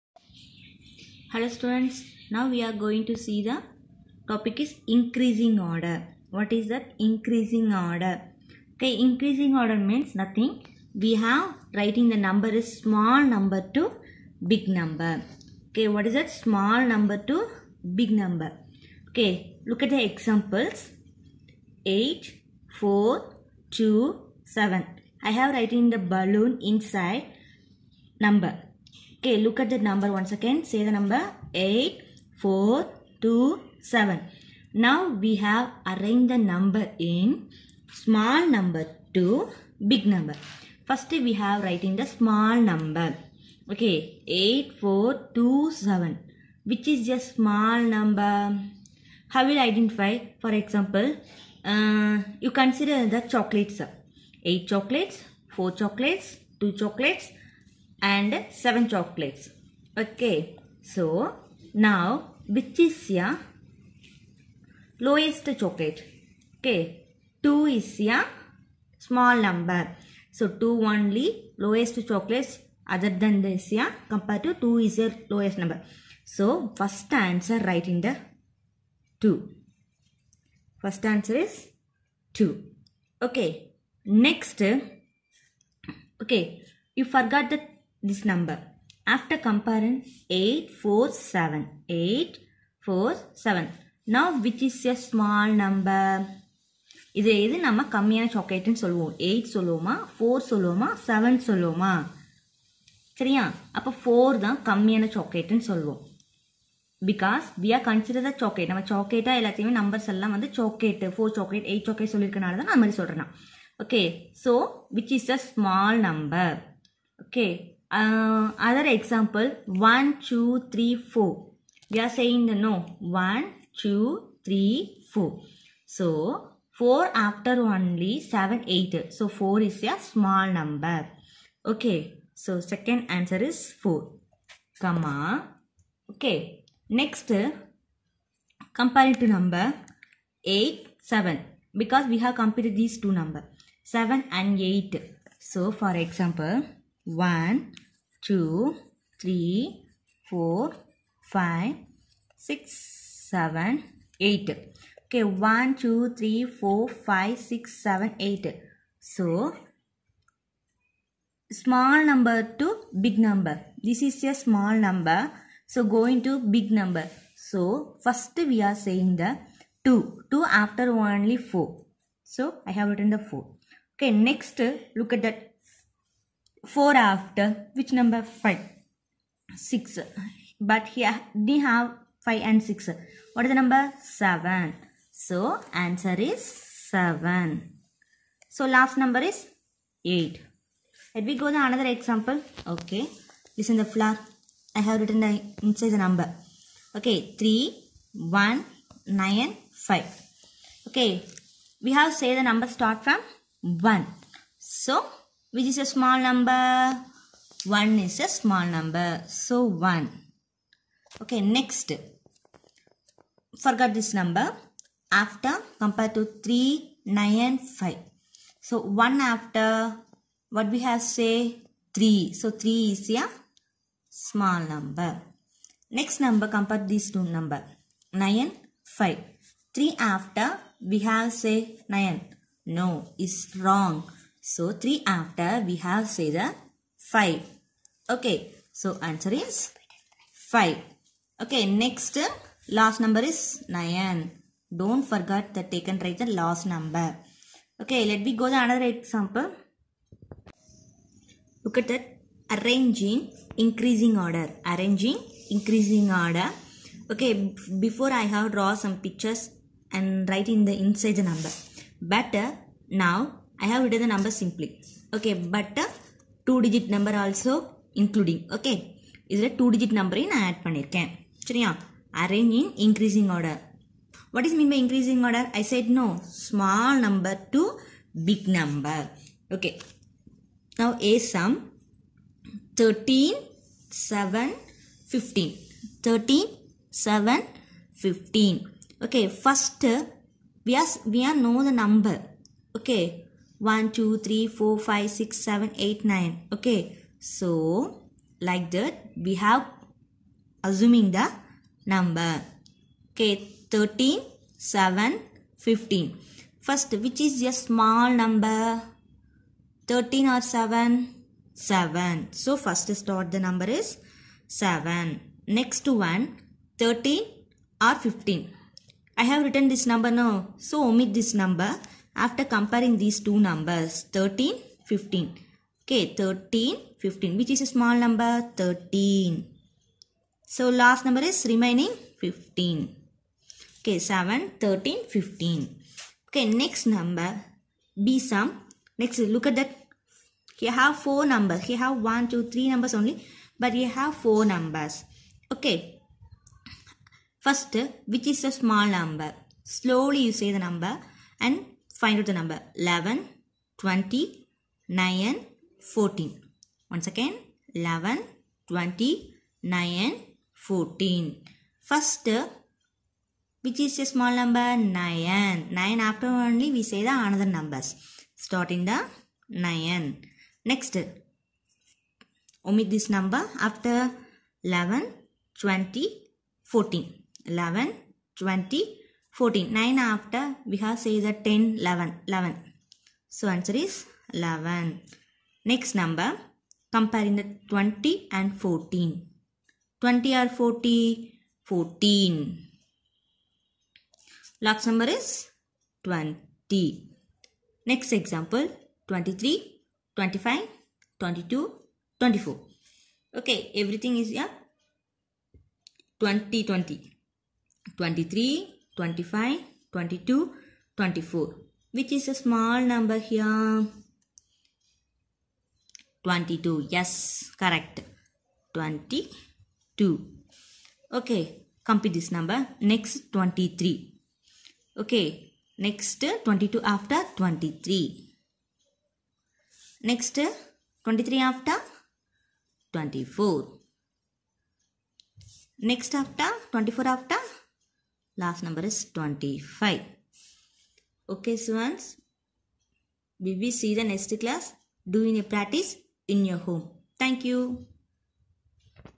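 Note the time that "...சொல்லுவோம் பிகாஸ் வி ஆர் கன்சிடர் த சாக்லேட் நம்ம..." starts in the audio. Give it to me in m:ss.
1:45.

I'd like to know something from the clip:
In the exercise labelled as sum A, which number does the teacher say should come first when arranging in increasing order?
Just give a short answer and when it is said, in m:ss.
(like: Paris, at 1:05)
7, at 5:12.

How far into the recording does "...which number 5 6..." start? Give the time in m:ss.
2:57.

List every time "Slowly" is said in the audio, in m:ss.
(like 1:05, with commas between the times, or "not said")
5:49.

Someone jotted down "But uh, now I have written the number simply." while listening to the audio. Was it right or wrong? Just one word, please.
right.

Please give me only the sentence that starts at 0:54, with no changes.
8 chocolates, 4 chocolates, 2 chocolates, and 7 chocolates.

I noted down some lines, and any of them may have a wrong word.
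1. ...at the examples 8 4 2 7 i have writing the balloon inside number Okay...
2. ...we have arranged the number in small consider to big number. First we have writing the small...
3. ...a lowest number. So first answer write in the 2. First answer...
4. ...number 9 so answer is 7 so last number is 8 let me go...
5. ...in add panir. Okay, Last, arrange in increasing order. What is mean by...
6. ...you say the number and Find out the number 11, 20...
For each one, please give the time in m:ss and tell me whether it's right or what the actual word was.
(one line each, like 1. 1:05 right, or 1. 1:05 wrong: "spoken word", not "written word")
1. 0:19 right
2. 0:35 wrong: "number", not "consider"
3. 1:14 right
4. 3:03 wrong: "7", not "9"
5. 4:30 wrong: "Chariya", not "Last"
6. 5:50 right.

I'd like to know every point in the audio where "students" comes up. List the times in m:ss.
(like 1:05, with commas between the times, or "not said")
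0:01, 7:21.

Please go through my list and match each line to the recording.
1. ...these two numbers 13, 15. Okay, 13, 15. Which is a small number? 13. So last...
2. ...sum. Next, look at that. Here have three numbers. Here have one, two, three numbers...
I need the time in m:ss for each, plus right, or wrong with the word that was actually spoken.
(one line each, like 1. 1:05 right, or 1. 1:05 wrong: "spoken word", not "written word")
1. 5:22 right
2. 5:38 wrong: "four", not "three".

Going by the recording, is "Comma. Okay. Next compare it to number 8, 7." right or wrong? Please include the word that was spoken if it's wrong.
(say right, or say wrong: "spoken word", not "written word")
right.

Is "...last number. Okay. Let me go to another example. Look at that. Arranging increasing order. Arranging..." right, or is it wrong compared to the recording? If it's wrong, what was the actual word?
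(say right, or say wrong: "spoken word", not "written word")
right.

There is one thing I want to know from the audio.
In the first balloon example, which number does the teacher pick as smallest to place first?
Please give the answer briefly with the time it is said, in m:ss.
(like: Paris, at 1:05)
2, at 1:10.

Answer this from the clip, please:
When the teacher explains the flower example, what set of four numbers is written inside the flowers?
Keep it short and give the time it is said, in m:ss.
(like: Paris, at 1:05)
3, 1, 9, 5, at 3:17.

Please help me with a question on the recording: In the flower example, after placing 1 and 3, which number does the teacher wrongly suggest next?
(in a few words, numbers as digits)
9.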